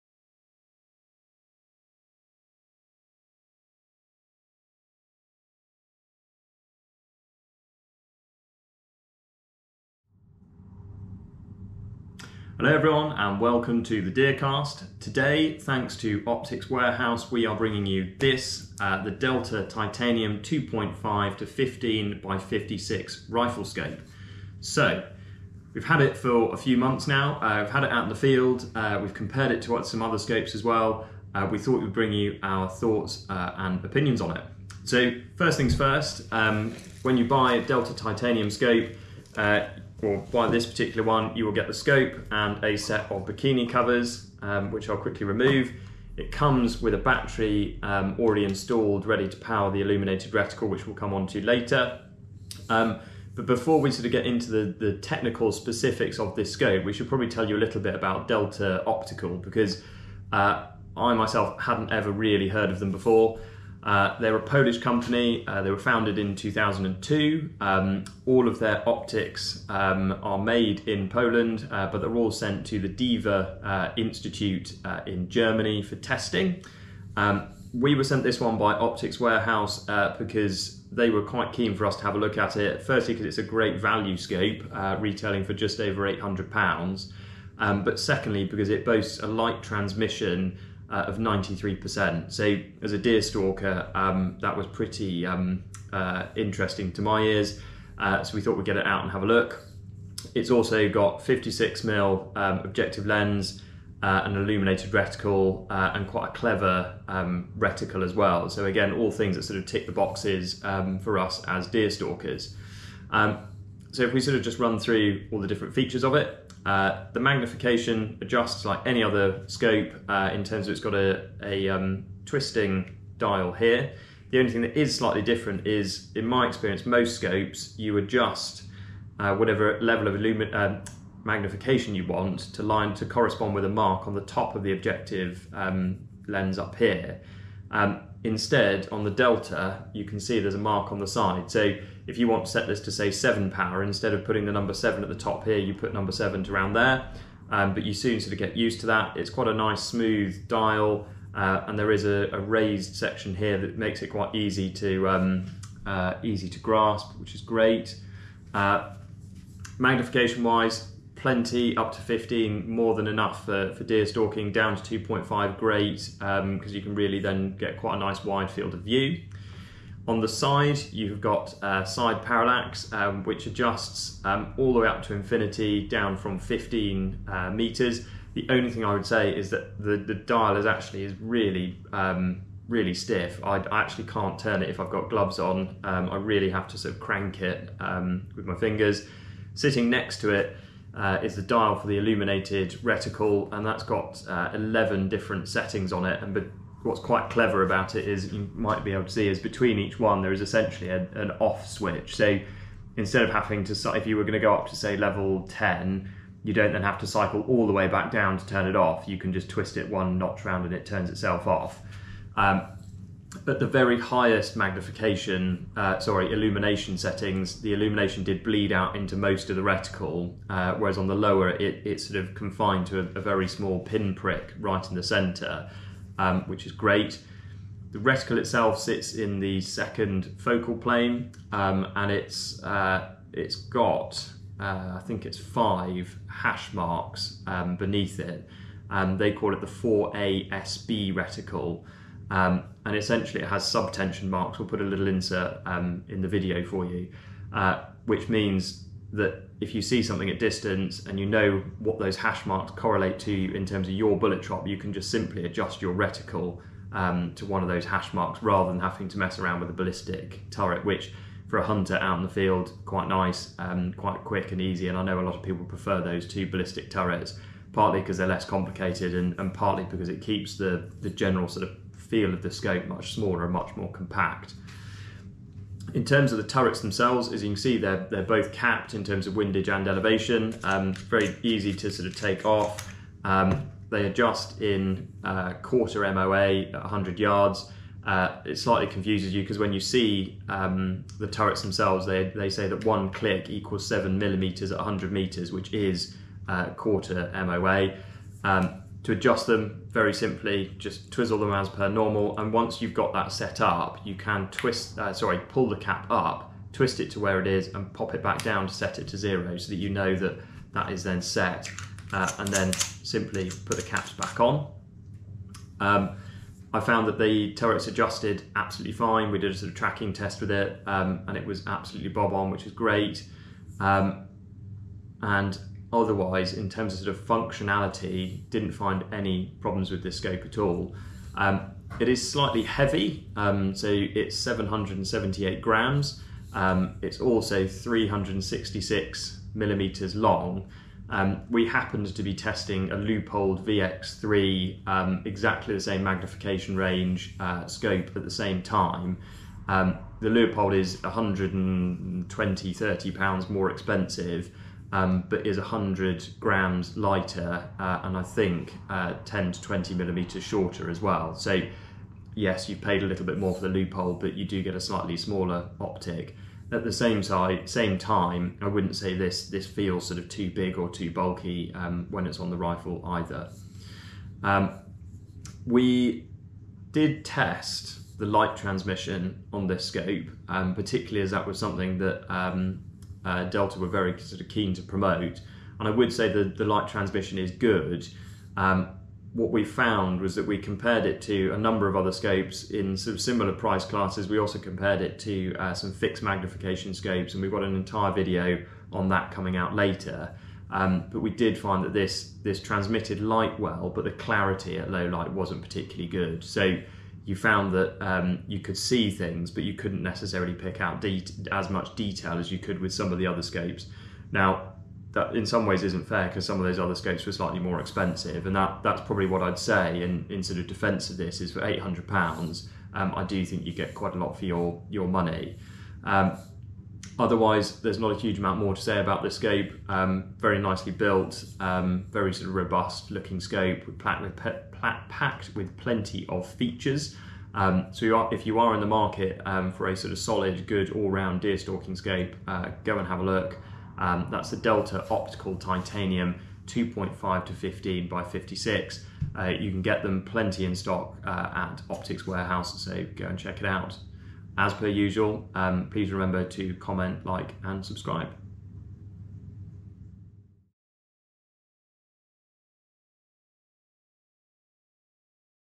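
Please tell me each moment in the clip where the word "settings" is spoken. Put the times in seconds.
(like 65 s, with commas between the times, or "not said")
195 s, 216 s.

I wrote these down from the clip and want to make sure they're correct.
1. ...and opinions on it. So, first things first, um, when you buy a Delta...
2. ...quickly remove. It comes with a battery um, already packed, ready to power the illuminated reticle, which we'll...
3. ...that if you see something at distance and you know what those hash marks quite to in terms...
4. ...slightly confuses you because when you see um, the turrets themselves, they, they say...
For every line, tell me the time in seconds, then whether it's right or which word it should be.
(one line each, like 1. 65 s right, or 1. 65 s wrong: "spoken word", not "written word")
1. 33 s right
2. 44 s wrong: "installed", not "packed"
3. 249 s wrong: "correlate", not "quite"
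4. 288 s right.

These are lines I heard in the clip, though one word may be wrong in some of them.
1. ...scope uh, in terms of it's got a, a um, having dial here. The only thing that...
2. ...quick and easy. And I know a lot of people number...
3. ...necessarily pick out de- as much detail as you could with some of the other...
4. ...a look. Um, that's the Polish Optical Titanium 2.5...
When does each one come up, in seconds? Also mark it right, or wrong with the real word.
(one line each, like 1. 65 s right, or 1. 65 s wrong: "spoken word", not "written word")
1. 119 s wrong: "twisting", not "having"
2. 264 s wrong: "prefer", not "number"
3. 410 s right
4. 443 s wrong: "Delta", not "Polish".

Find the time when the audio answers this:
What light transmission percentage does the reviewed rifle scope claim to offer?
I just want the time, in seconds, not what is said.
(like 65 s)
91 s.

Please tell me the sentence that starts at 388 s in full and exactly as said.
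Um, what we found was that we compared it to a number of other scopes in sort of similar price classes.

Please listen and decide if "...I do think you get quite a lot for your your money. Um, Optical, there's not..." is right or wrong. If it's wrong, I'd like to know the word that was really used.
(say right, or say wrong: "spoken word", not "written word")
wrong: "Otherwise", not "Optical".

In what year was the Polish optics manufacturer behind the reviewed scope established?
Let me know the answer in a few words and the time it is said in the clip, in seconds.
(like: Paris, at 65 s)
2002, at 66 s.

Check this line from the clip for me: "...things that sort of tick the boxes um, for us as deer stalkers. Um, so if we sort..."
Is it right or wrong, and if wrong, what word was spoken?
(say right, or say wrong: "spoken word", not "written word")
right.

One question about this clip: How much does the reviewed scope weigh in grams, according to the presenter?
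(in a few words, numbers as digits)
778 grams.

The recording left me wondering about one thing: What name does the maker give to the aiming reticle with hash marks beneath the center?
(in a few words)
4ASB.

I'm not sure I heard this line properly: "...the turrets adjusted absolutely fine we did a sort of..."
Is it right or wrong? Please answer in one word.
right.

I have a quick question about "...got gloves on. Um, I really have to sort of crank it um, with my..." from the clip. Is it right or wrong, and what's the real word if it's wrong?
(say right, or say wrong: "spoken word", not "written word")
right.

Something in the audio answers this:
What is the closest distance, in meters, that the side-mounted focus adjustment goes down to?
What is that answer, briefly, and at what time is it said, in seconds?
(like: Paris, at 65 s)
15 meters, at 176 s.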